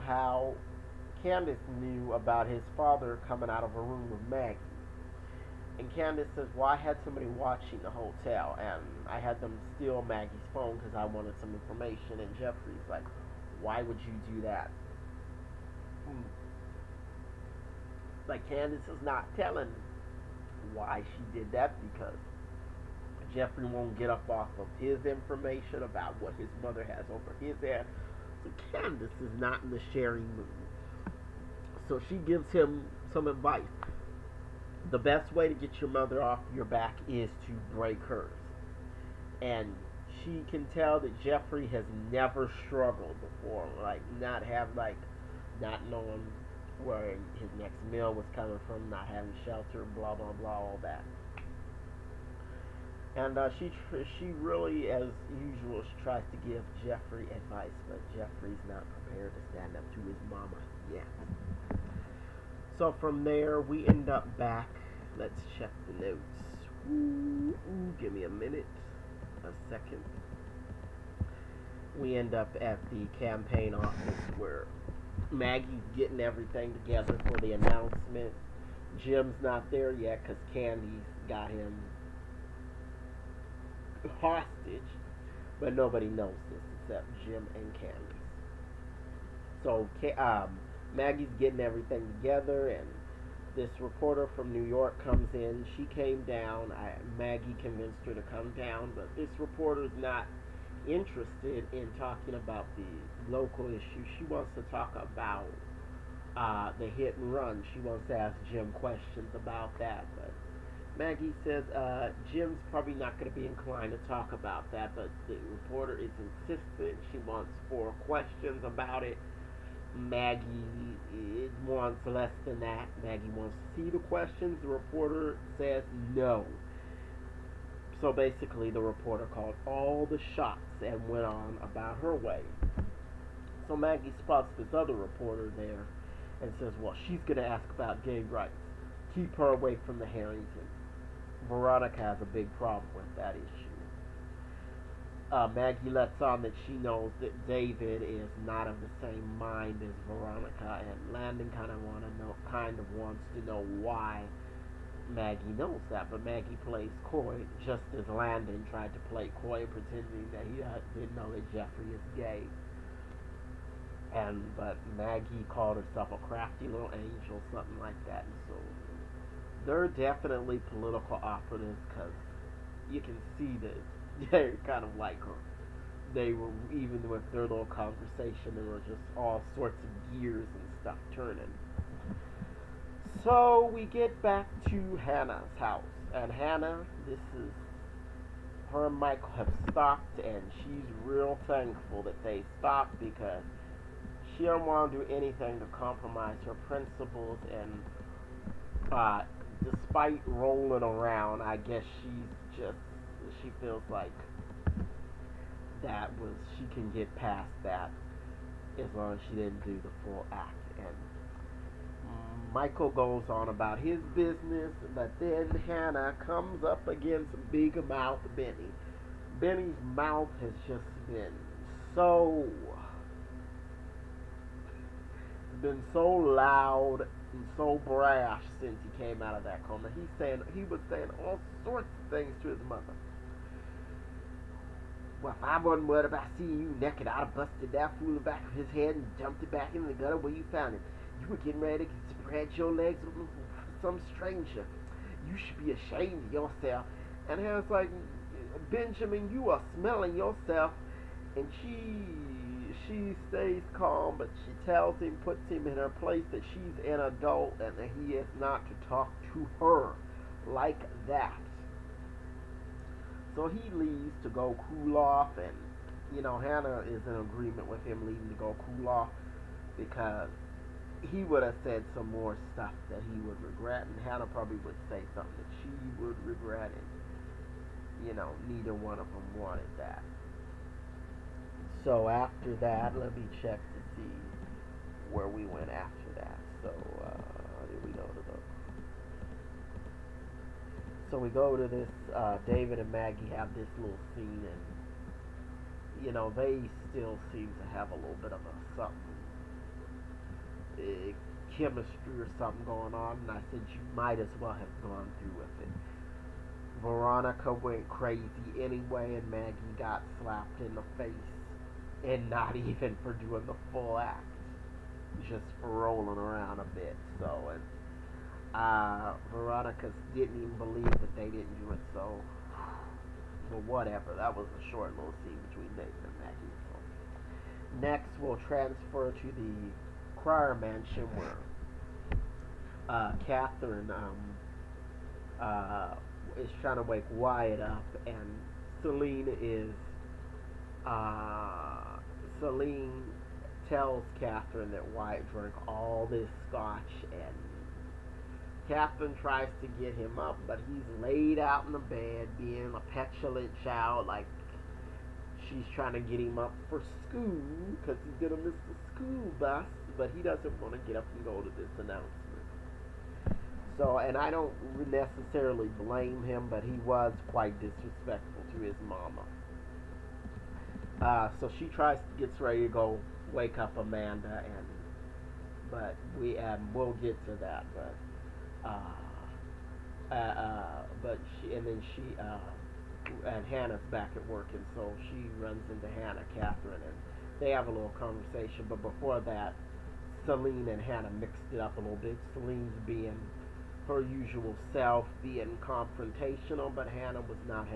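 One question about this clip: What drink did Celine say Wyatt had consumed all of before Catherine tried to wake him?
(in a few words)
scotch.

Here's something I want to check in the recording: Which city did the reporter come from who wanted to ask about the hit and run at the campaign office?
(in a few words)
New York.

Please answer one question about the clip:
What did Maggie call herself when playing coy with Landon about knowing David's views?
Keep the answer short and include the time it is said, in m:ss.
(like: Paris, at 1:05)
crafty little angel, at 2:46.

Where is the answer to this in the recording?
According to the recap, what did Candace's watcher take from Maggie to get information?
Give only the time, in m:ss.
0:10.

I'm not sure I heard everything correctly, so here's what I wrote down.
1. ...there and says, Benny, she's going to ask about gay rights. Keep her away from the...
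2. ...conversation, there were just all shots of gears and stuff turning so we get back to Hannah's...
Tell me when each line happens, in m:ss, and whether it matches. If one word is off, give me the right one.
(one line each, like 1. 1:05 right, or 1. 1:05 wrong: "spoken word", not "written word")
1. 2:15 wrong: "Well", not "Benny"
2. 2:57 wrong: "sorts", not "shots".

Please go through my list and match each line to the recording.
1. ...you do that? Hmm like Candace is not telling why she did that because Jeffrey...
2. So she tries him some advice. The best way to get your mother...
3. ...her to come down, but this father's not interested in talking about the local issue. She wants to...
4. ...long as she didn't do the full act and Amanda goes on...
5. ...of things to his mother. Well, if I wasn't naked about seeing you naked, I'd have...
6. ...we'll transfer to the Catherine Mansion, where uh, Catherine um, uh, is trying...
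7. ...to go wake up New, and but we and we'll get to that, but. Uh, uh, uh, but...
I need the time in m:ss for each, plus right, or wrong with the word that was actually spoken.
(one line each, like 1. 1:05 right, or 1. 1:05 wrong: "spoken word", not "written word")
1. 0:14 right
2. 0:31 wrong: "gives", not "tries"
3. 1:38 wrong: "reporter", not "father"
4. 3:28 wrong: "Michael", not "Amanda"
5. 3:52 wrong: "worried", not "naked"
6. 5:28 wrong: "Cryer", not "Catherine"
7. 6:12 wrong: "Amanda", not "New".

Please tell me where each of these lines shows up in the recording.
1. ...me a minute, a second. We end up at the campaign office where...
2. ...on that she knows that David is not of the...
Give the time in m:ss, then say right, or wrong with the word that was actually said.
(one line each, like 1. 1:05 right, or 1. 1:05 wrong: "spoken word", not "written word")
1. 1:08 right
2. 2:26 right.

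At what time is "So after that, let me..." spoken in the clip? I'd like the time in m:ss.
4:41.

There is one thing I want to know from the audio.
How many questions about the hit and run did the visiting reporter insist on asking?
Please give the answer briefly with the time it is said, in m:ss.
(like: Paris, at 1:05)
4, at 1:57.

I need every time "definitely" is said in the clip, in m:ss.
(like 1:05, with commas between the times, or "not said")
2:49.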